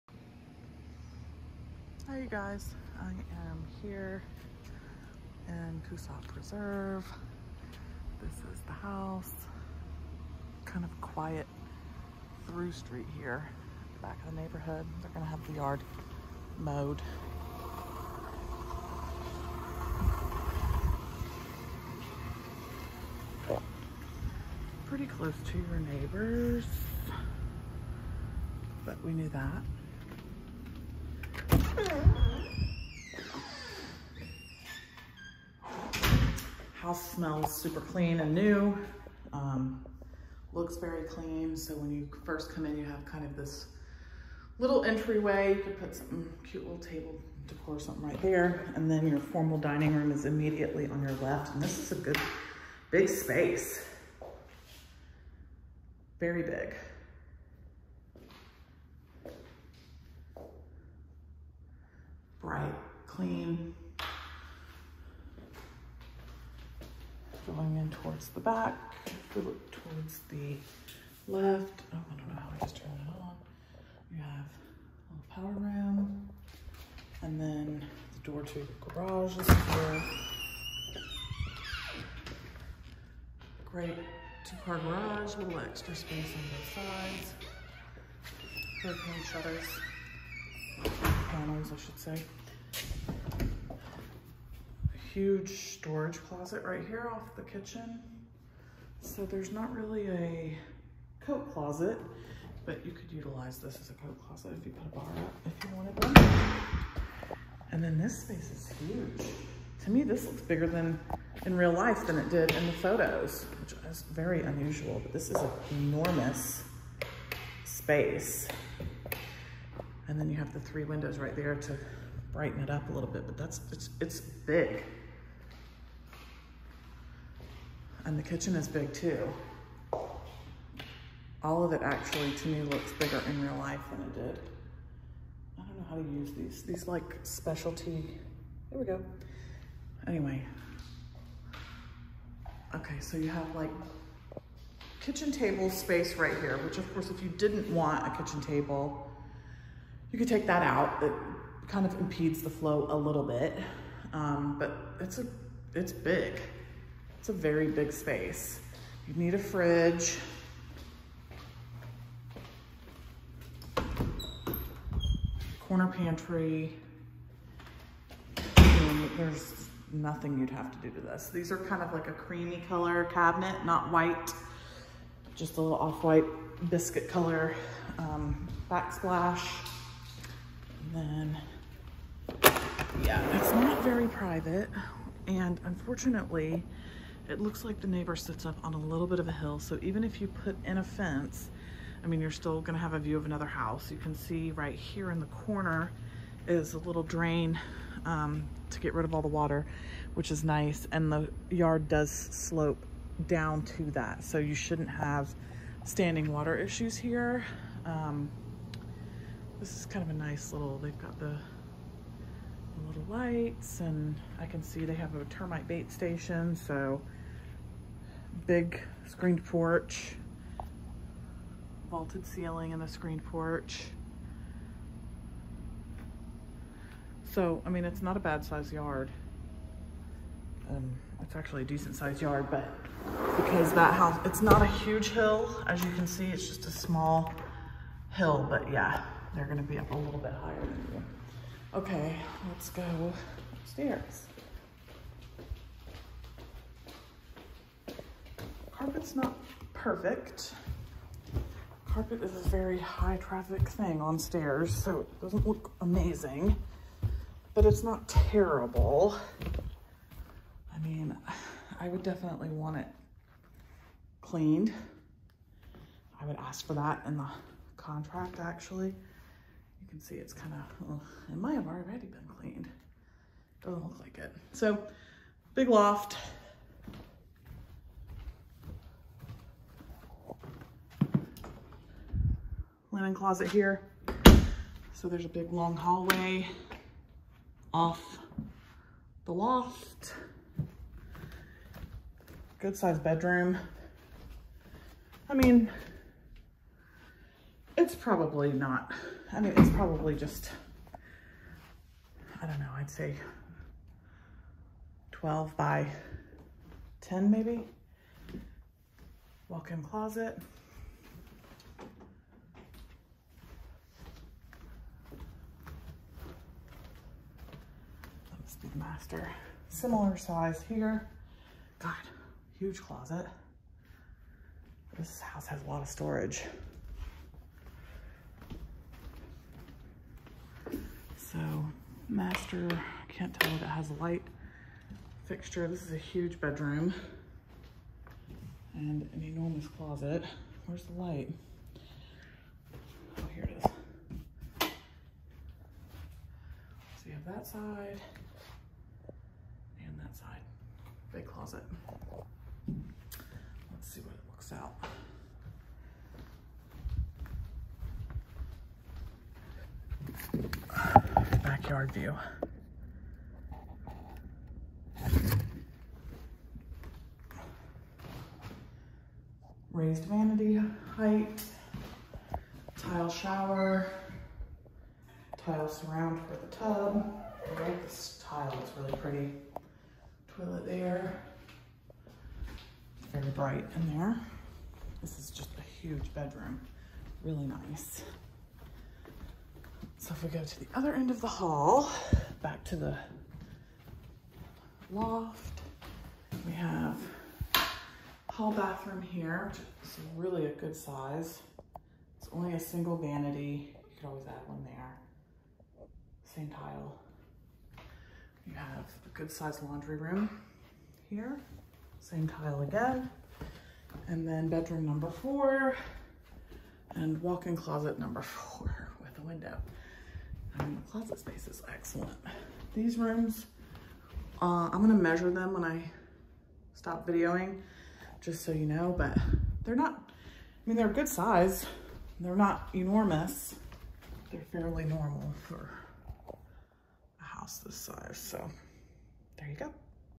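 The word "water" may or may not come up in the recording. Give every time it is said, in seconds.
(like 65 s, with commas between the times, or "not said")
199 s, 206 s.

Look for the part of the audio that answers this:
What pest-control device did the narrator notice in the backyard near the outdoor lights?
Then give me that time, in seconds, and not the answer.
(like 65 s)
215 s.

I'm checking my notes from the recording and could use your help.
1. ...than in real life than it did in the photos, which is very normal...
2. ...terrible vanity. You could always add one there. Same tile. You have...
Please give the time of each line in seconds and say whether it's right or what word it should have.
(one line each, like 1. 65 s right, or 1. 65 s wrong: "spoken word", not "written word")
1. 110 s wrong: "unusual", not "normal"
2. 402 s wrong: "single", not "terrible".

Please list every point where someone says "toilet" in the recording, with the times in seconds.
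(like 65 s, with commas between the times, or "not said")
380 s.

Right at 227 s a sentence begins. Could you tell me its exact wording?
So, I mean, it's not a bad size yard.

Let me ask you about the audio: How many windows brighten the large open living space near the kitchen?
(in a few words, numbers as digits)
3.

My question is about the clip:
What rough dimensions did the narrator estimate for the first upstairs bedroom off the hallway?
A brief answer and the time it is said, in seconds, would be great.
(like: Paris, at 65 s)
12 by 10, at 305 s.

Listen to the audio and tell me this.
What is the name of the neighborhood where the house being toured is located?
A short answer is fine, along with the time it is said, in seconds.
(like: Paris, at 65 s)
Coosaw Preserve, at 5 s.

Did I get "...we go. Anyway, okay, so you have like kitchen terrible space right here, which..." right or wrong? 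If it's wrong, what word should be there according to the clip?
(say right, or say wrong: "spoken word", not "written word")
wrong: "table", not "terrible".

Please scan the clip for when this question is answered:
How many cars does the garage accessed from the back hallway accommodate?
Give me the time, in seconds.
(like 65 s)
84 s.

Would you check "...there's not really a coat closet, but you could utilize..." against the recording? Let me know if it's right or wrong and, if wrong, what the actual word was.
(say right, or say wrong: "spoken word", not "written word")
right.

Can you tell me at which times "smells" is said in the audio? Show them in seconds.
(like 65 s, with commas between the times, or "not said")
37 s.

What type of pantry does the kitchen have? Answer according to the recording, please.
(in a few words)
Corner pantry.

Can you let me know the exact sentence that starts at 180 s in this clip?
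And then, yeah, it's not very private.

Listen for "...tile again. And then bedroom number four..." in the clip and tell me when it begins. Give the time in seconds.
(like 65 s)
412 s.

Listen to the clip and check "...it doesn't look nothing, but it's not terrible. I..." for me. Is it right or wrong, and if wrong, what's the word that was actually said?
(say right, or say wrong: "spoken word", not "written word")
wrong: "amazing", not "nothing".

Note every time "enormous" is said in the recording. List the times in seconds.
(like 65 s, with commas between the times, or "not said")
115 s, 339 s, 432 s.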